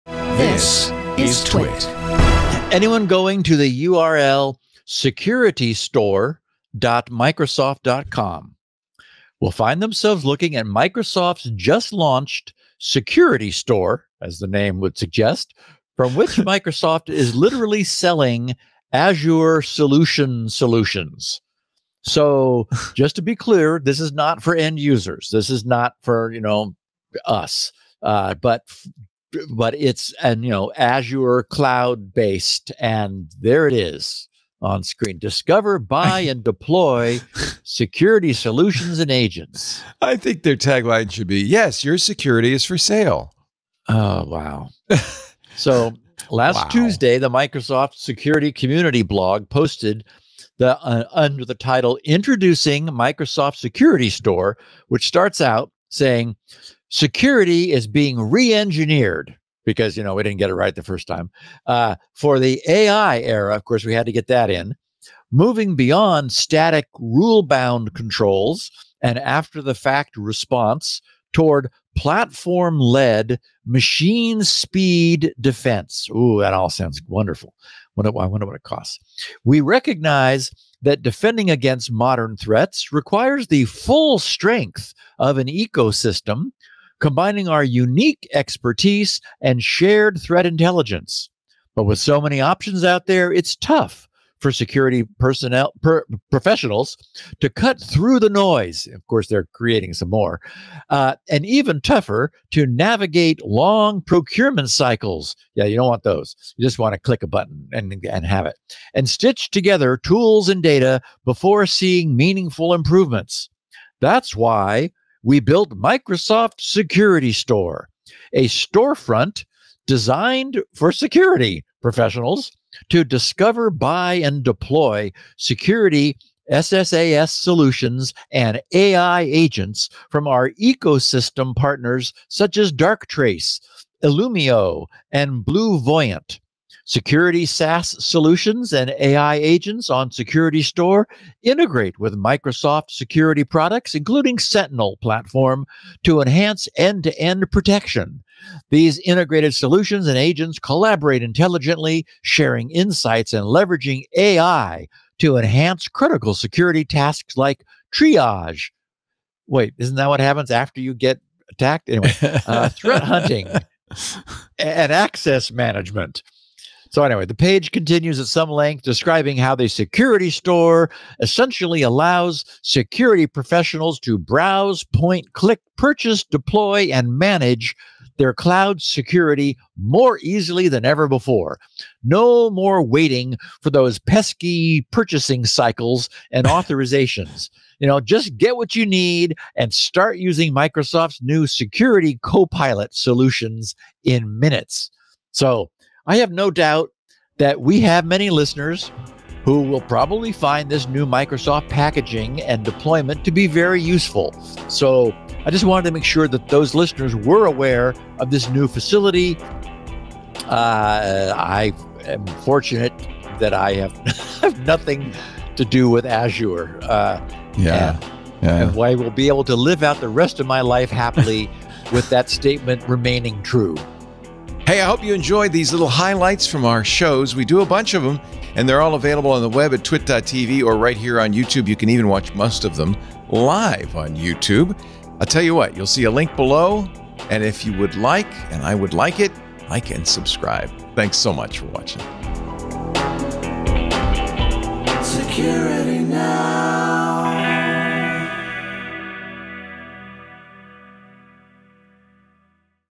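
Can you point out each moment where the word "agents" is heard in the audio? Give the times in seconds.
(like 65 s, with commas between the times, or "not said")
39 s, 129 s, 139 s, 150 s.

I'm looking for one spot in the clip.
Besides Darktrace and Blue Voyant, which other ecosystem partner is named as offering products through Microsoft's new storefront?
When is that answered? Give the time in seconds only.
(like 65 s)
134 s.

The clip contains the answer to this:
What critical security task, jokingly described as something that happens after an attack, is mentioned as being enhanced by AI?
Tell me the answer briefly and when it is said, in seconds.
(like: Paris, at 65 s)
Triage, at 157 s.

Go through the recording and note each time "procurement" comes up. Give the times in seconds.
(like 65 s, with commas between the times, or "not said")
104 s.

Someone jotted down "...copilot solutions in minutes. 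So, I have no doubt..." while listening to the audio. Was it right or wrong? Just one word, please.
right.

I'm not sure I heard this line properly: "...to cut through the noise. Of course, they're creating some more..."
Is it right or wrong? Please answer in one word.
right.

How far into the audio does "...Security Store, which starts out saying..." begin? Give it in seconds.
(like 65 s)
53 s.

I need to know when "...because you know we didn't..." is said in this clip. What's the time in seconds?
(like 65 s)
59 s.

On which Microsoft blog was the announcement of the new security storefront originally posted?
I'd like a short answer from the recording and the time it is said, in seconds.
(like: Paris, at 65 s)
Microsoft Security Community blog, at 47 s.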